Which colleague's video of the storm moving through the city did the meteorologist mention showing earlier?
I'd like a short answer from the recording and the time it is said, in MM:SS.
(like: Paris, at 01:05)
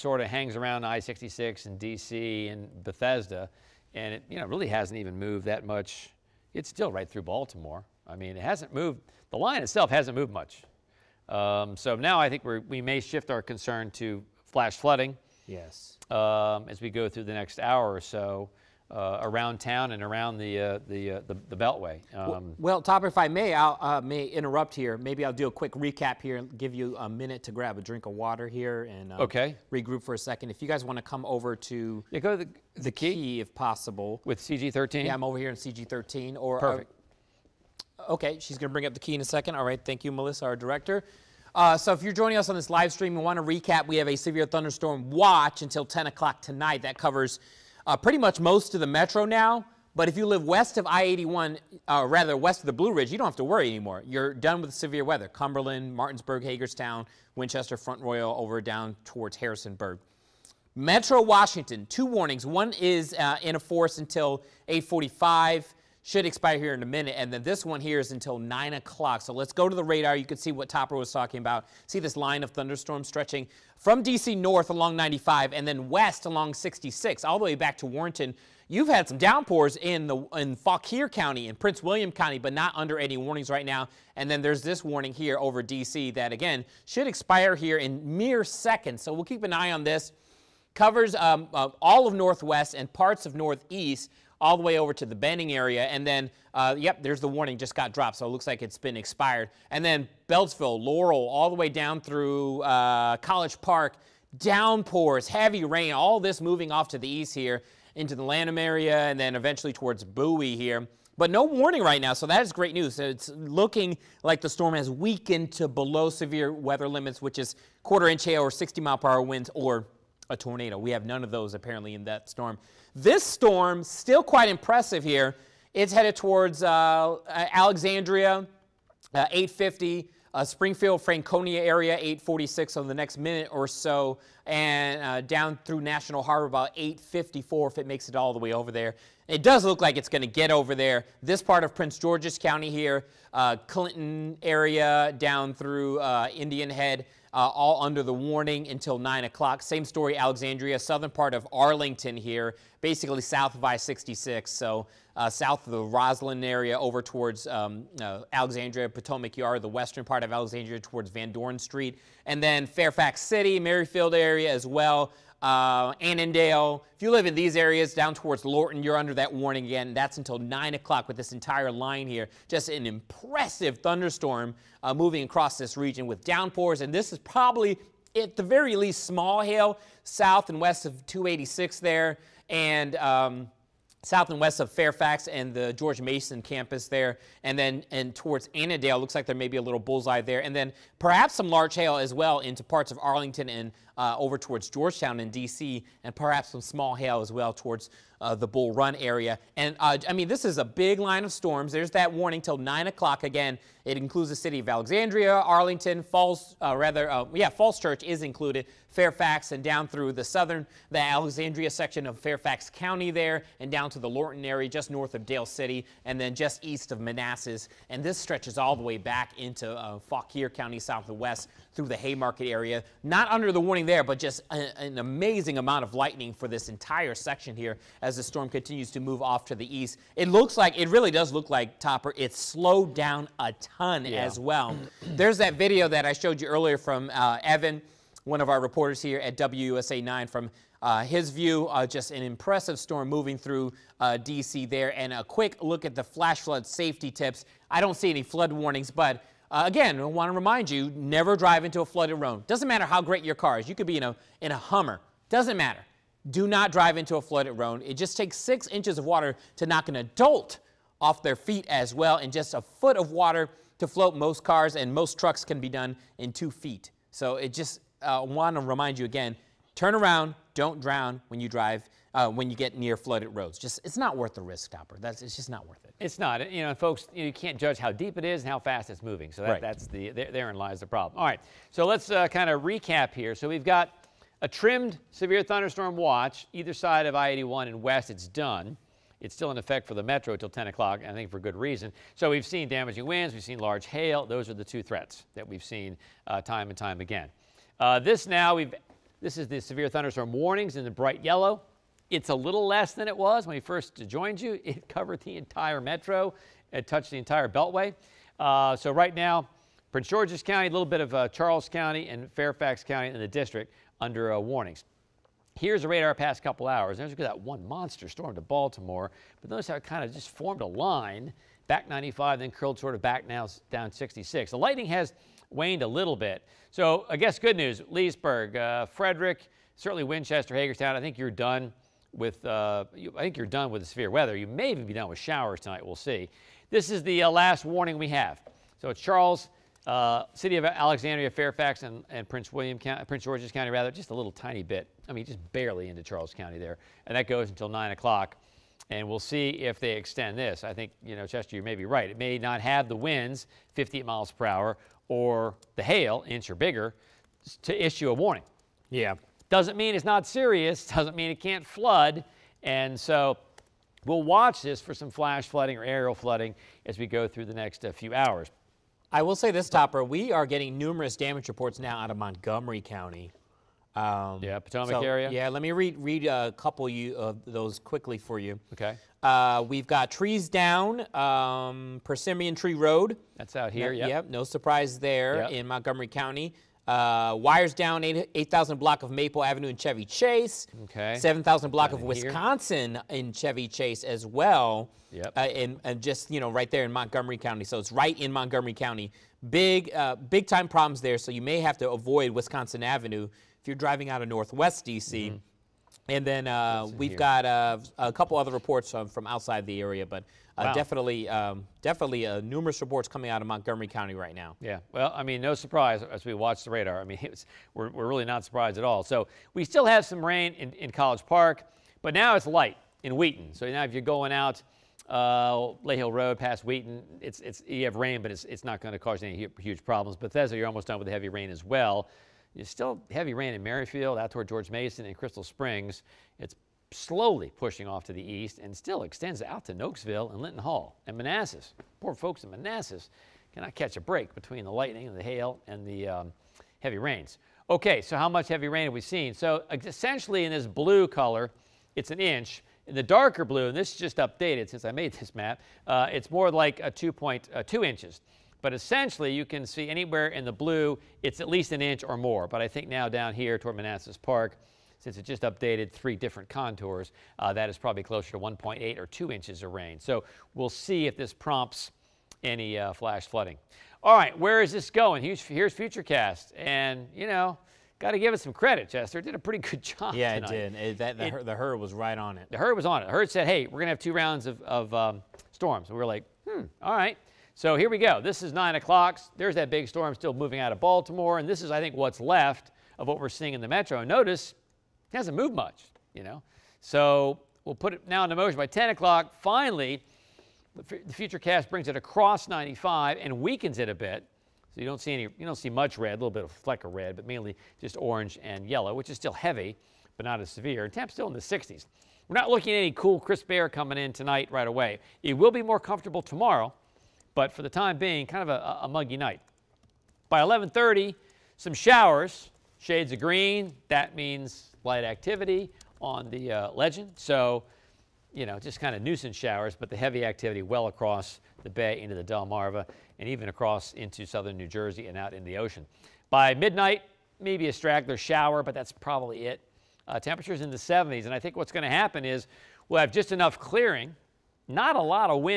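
Evan, at 03:57.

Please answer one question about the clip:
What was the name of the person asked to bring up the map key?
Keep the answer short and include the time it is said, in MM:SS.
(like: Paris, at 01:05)
Melissa, at 00:40.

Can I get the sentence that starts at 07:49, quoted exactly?
So we'll see if this prompts any uh, flash flooding.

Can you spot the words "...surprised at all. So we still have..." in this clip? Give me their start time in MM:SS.
06:58.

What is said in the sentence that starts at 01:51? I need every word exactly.
But no warning right now, so that is great news.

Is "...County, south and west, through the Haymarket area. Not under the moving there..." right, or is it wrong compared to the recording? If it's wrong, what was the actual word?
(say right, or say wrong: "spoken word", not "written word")
wrong: "warning", not "moving".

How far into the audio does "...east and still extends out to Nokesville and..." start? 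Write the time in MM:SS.
07:18.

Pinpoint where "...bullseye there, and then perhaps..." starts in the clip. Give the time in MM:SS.
03:09.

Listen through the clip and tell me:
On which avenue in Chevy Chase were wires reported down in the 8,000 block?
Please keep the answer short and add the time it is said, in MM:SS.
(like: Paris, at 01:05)
Maple Avenue, at 06:29.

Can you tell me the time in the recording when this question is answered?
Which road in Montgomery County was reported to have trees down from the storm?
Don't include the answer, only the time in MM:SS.
06:22.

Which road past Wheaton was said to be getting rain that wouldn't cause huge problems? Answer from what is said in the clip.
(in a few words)
Lay Hill Road.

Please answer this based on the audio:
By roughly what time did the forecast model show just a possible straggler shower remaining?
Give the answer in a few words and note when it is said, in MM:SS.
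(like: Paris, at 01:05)
Midnight, at 08:56.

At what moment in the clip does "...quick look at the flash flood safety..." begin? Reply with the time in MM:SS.
04:05.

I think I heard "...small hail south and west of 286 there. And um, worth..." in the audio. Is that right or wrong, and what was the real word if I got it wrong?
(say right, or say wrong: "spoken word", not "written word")
wrong: "south", not "worth".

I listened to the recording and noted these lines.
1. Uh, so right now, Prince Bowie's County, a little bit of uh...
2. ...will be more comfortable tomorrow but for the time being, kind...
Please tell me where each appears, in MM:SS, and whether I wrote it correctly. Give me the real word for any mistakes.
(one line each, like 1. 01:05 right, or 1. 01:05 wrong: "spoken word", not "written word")
1. 05:08 wrong: "George", not "Bowie"
2. 08:35 right.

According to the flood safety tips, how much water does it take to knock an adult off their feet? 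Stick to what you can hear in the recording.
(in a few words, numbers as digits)
six inches.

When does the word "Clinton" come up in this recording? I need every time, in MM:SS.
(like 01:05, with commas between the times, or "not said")
02:23.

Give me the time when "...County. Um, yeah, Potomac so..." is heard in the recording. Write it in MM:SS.
06:12.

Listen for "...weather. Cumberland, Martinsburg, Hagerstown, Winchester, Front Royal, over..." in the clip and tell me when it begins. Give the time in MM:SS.
00:55.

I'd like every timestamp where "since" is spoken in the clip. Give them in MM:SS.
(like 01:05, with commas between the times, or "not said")
07:34, 07:44.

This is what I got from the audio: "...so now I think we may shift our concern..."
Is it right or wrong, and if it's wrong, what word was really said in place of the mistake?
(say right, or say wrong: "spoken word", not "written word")
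right.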